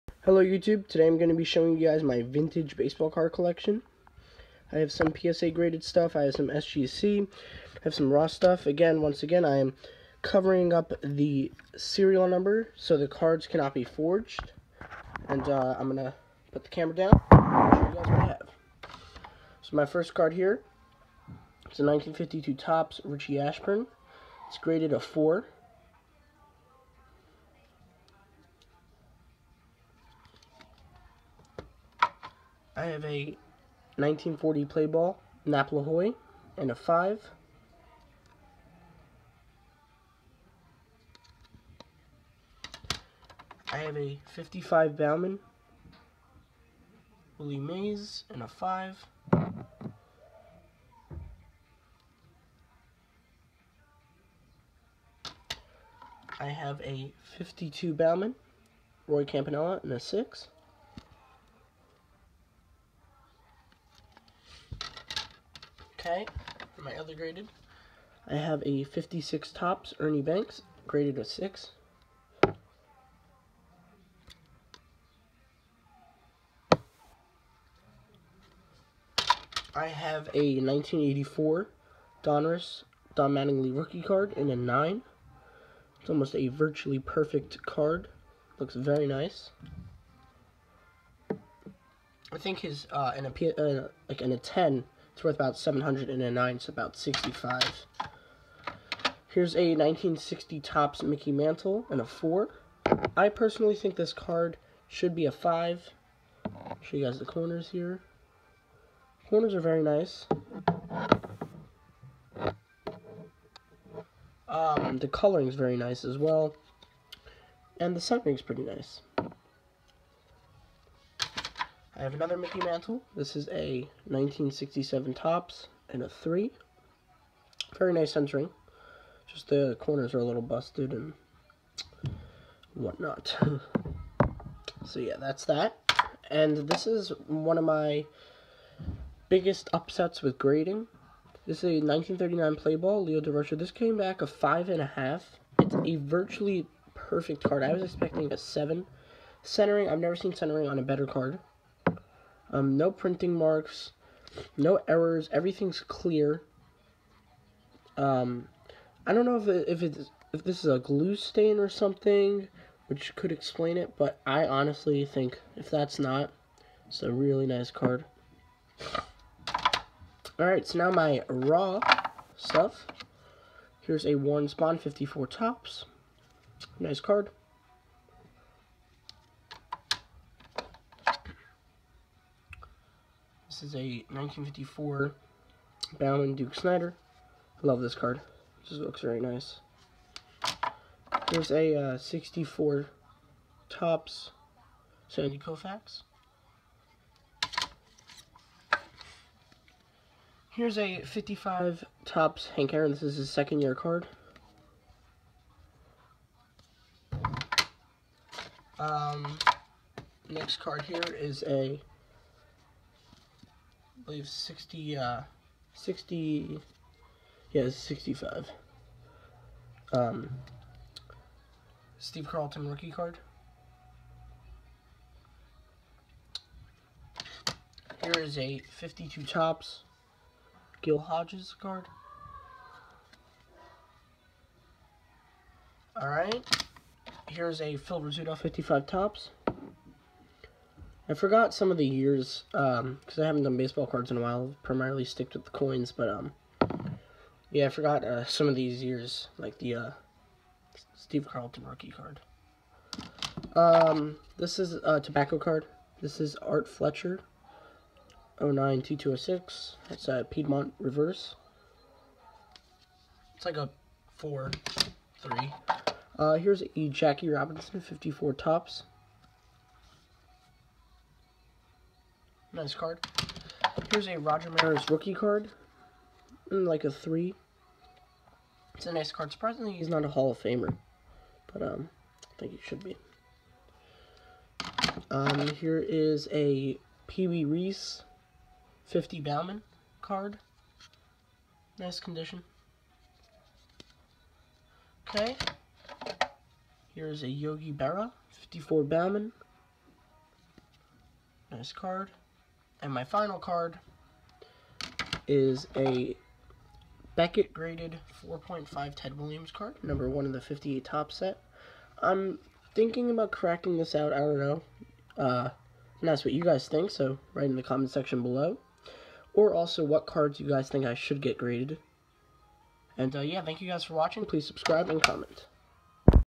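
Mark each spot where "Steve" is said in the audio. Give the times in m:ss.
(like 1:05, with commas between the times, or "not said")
3:41, 4:10.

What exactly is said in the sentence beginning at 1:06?
Okay, for my other graded, I have a 56 Topps Ernie Banks, graded a 6.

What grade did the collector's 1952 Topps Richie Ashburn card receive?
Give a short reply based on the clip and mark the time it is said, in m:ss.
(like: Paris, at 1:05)
4, at 0:24.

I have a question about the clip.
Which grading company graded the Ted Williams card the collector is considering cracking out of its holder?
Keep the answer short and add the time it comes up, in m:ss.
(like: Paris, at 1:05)
Beckett, at 5:07.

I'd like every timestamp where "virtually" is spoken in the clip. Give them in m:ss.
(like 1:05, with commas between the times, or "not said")
1:26, 2:25.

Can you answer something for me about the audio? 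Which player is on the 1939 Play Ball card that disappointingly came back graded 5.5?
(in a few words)
Leo Durocher.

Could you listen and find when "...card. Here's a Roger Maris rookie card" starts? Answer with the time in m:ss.
4:32.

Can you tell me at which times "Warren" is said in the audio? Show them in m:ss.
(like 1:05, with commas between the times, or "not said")
2:54.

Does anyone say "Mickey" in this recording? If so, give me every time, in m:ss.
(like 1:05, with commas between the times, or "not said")
1:41, 2:02.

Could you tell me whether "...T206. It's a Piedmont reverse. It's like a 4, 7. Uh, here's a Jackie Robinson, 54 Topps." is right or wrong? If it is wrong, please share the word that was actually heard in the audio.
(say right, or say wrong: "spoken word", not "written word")
wrong: "3", not "7".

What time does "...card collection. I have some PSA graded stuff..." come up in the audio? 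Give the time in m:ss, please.
0:03.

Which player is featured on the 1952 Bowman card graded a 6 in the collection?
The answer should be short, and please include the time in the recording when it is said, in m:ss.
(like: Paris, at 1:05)
Roy Campanella, at 0:59.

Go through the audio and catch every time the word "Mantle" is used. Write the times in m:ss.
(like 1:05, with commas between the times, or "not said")
1:41, 2:02.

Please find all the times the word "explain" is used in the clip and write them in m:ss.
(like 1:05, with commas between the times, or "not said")
2:43.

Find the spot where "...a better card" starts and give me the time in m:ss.
2:30.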